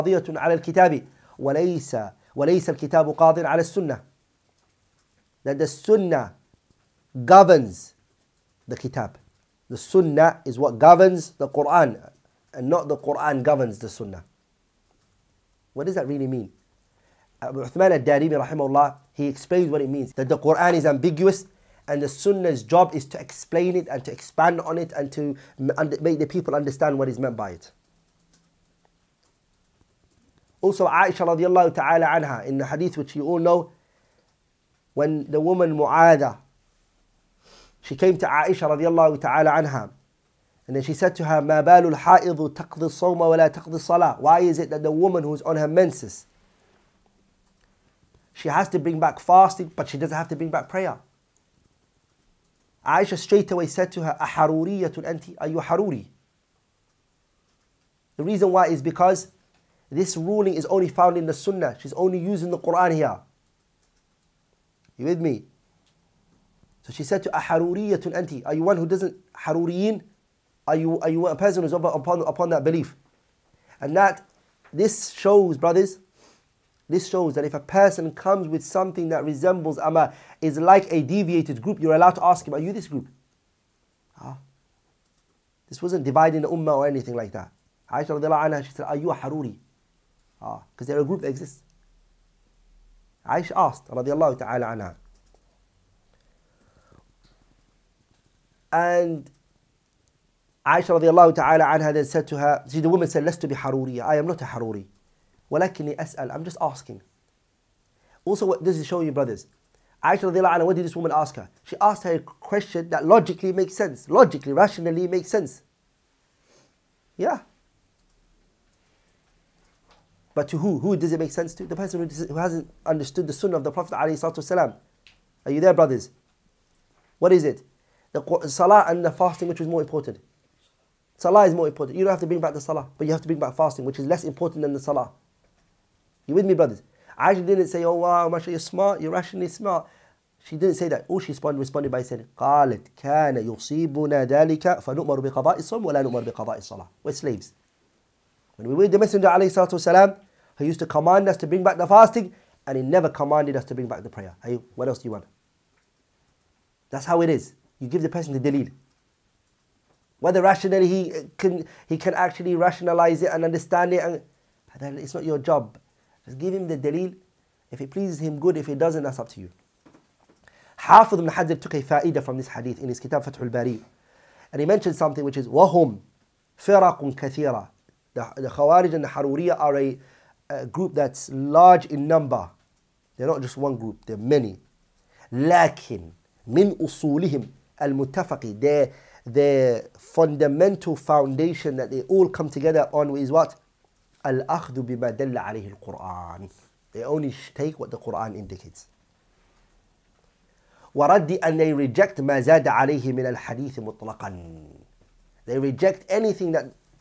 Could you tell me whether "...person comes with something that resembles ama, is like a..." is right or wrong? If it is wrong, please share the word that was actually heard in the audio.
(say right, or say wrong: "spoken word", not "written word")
right.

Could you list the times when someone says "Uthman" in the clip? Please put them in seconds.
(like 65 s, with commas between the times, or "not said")
17 s.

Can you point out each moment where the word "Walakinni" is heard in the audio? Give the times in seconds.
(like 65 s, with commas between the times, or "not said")
105 s.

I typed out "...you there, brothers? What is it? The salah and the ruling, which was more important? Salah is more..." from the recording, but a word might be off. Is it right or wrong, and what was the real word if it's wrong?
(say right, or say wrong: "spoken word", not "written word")
wrong: "fasting", not "ruling".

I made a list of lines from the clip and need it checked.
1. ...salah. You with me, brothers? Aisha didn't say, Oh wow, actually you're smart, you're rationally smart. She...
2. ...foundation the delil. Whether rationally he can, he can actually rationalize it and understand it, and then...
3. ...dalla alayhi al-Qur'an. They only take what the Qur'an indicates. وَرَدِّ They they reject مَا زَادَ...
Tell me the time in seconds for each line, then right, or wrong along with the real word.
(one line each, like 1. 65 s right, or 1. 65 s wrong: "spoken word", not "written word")
1. 134 s right
2. 158 s wrong: "person", not "foundation"
3. 195 s wrong: "And", not "They".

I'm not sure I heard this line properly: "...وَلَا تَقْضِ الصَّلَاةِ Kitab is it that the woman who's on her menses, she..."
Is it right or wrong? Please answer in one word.
wrong.